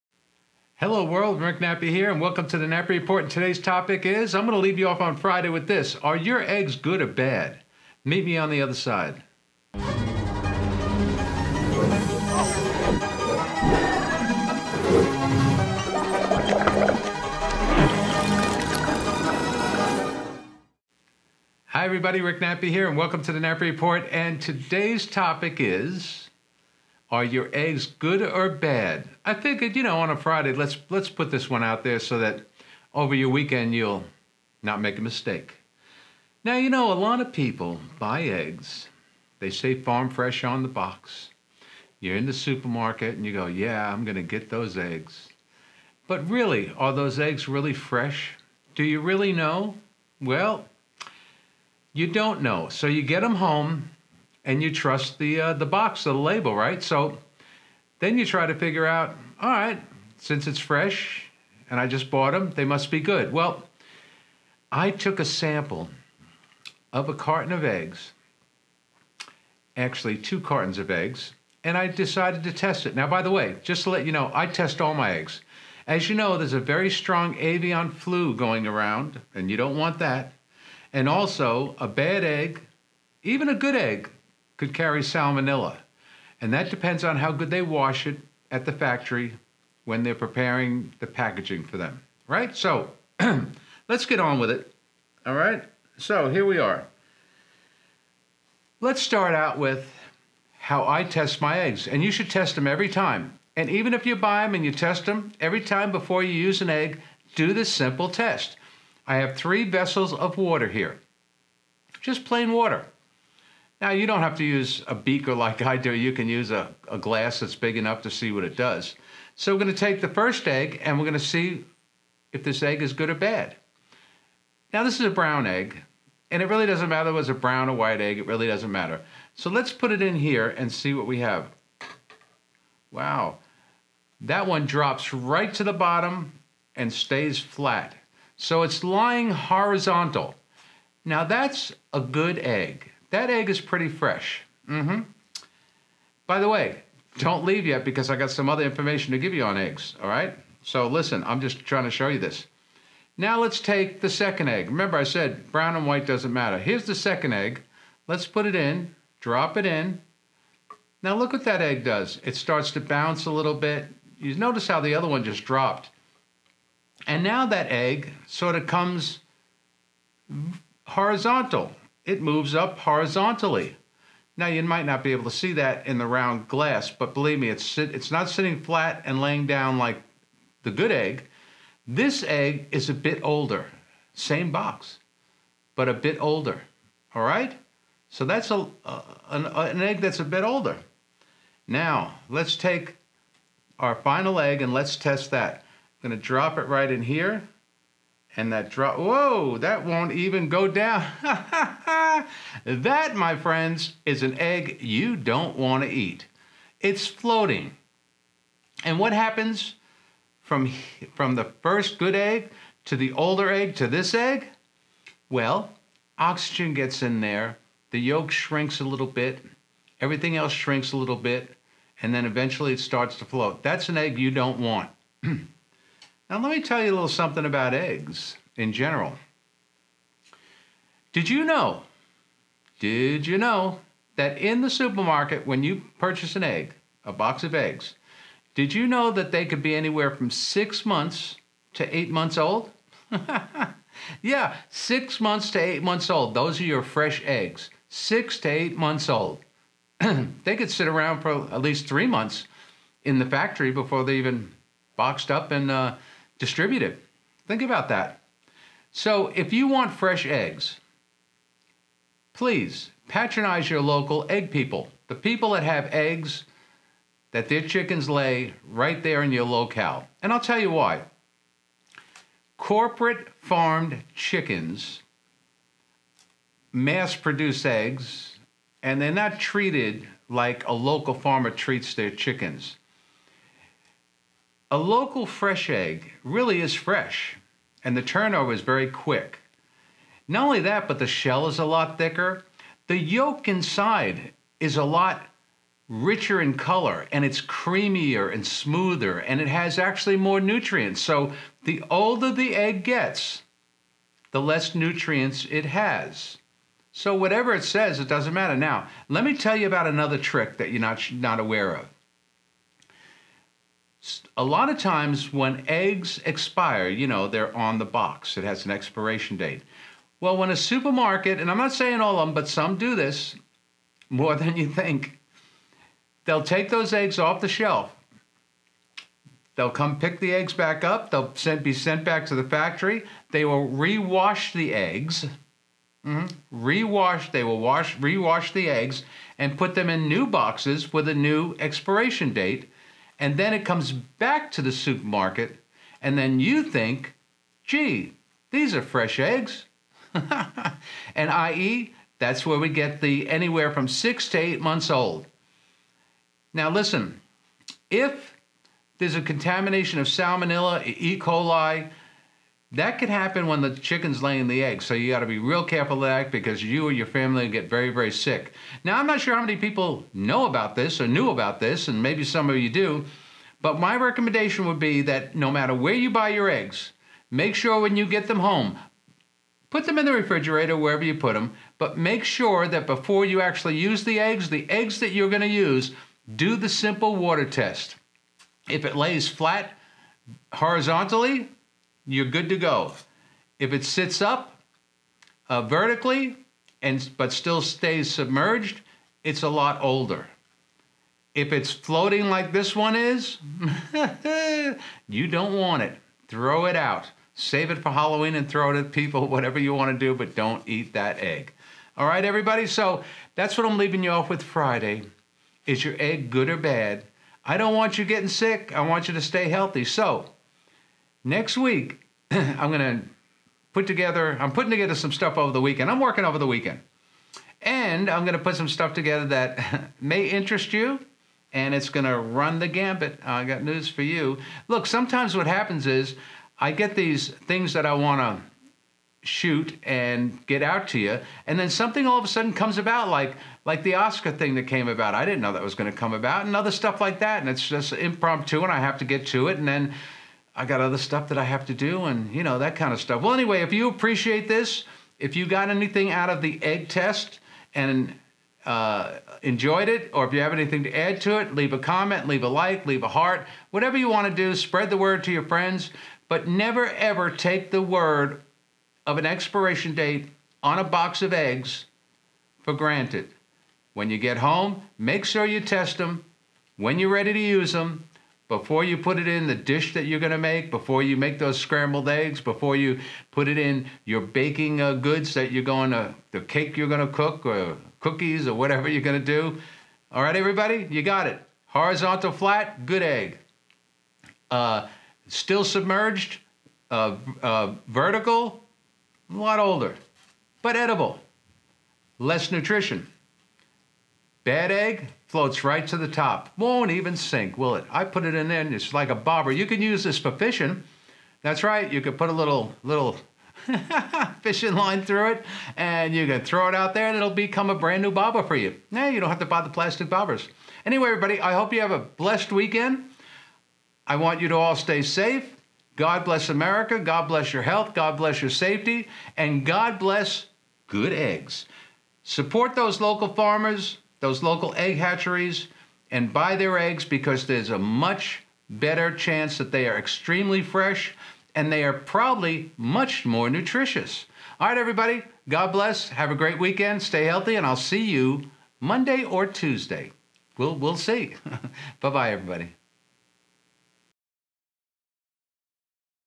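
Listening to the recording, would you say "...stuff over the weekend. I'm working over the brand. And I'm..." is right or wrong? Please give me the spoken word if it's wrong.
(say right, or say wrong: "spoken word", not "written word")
wrong: "weekend", not "brand".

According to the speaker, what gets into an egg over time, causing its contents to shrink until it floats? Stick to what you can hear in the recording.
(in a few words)
Oxygen.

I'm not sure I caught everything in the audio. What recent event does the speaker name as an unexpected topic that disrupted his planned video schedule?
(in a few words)
The Oscar thing.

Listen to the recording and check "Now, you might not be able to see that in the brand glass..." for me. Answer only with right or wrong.
wrong.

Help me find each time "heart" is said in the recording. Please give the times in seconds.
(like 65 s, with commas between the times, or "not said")
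463 s.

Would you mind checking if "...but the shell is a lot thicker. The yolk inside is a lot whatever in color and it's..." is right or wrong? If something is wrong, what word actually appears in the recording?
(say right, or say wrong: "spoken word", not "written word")
wrong: "richer", not "whatever".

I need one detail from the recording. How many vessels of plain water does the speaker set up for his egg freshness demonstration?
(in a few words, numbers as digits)
3.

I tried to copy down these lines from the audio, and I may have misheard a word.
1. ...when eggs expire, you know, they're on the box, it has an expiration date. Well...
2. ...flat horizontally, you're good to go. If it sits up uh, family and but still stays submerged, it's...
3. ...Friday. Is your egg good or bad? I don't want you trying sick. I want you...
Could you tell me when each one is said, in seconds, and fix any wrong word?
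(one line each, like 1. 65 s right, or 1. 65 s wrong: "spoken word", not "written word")
1. 315 s right
2. 389 s wrong: "vertically", not "family"
3. 414 s wrong: "getting", not "trying".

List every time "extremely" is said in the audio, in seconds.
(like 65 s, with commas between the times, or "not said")
539 s.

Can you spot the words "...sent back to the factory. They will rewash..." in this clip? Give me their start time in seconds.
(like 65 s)
331 s.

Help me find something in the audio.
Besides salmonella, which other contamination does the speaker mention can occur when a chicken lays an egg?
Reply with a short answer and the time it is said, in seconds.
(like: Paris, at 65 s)
E. coli, at 360 s.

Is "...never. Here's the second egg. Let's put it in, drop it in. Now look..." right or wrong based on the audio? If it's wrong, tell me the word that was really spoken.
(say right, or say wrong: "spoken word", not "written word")
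wrong: "matter", not "never".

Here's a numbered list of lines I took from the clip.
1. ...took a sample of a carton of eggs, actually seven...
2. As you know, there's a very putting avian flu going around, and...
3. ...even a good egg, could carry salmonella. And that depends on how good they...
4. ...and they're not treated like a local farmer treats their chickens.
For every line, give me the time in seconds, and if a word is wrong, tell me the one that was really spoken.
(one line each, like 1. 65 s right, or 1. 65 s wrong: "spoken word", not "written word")
1. 64 s wrong: "two", not "seven"
2. 75 s wrong: "strong", not "putting"
3. 83 s right
4. 278 s right.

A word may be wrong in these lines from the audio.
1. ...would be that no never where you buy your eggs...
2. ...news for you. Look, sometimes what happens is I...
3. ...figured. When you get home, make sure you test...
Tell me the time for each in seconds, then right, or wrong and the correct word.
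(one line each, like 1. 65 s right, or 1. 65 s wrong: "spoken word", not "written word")
1. 374 s wrong: "matter", not "never"
2. 433 s right
3. 472 s wrong: "granted", not "figured".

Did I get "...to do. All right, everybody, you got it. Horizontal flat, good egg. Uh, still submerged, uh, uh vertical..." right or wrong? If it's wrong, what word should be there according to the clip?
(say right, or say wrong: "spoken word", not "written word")
right.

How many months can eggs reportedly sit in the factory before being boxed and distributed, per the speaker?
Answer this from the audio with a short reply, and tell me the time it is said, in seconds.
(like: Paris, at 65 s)
3, at 251 s.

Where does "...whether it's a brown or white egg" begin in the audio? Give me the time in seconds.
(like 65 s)
127 s.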